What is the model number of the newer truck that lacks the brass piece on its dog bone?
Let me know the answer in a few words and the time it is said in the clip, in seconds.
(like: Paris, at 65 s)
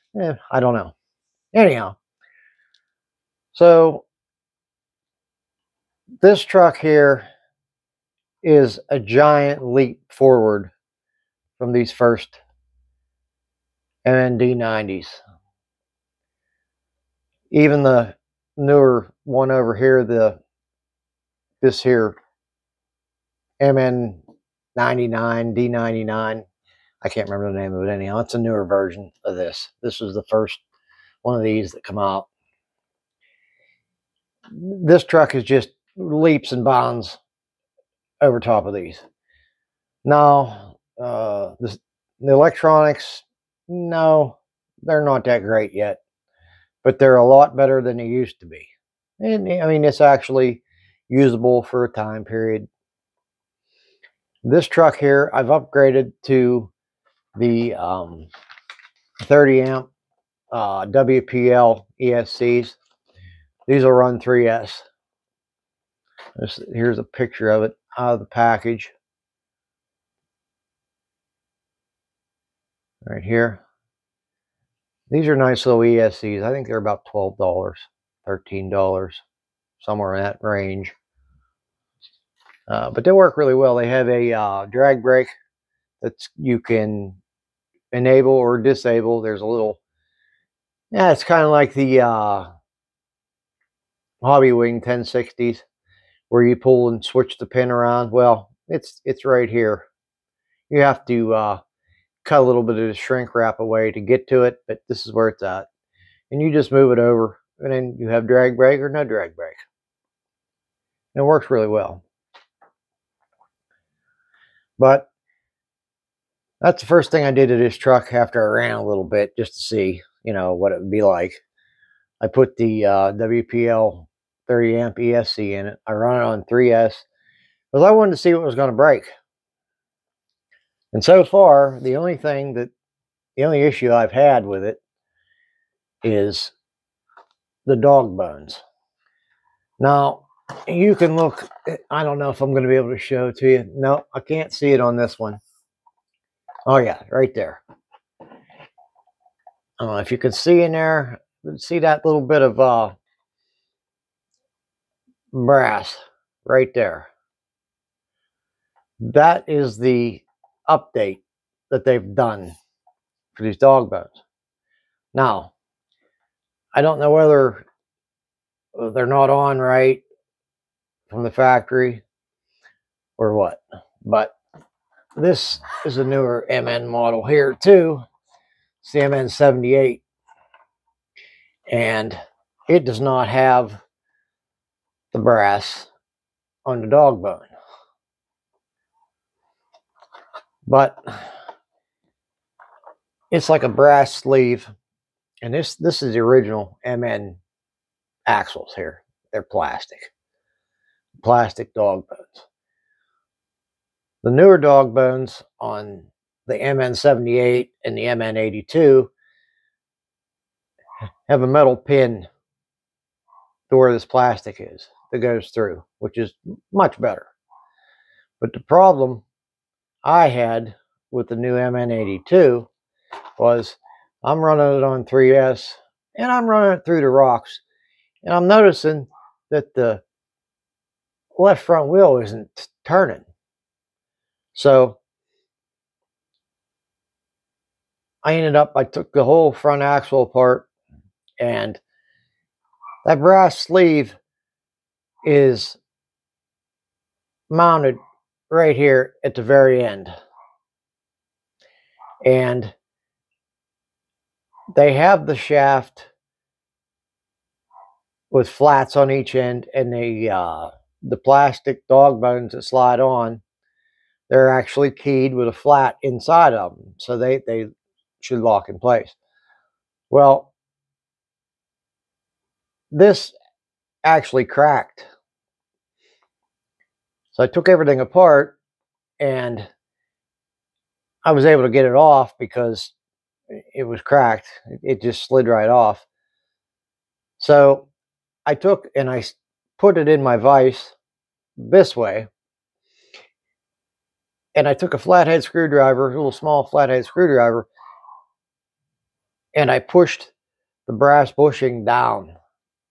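MN78, at 179 s.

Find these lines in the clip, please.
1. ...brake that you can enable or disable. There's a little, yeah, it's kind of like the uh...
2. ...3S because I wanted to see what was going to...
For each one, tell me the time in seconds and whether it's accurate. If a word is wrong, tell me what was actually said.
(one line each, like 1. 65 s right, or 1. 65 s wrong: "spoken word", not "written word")
1. 85 s right
2. 126 s right.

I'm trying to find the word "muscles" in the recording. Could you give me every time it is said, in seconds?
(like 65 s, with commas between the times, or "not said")
not said.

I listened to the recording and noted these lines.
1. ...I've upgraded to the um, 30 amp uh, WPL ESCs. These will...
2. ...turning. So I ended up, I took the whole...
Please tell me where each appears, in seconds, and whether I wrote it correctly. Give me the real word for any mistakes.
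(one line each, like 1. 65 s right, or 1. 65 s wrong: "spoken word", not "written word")
1. 55 s right
2. 232 s right.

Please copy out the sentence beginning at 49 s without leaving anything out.
And I mean, it's actually usable for a time period.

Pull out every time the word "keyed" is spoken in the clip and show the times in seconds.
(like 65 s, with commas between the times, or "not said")
264 s.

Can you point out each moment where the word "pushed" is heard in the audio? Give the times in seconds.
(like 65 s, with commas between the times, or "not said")
299 s.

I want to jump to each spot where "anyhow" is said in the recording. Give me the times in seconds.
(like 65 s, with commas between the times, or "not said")
1 s, 27 s.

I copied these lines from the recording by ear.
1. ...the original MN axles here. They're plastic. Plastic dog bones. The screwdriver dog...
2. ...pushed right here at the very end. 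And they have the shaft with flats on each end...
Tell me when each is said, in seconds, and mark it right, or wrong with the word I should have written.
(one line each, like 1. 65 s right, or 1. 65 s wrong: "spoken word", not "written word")
1. 196 s wrong: "newer", not "screwdriver"
2. 247 s wrong: "mounted", not "pushed".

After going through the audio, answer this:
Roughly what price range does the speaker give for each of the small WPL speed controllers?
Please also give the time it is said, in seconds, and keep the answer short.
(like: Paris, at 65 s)
$12-$13, at 77 s.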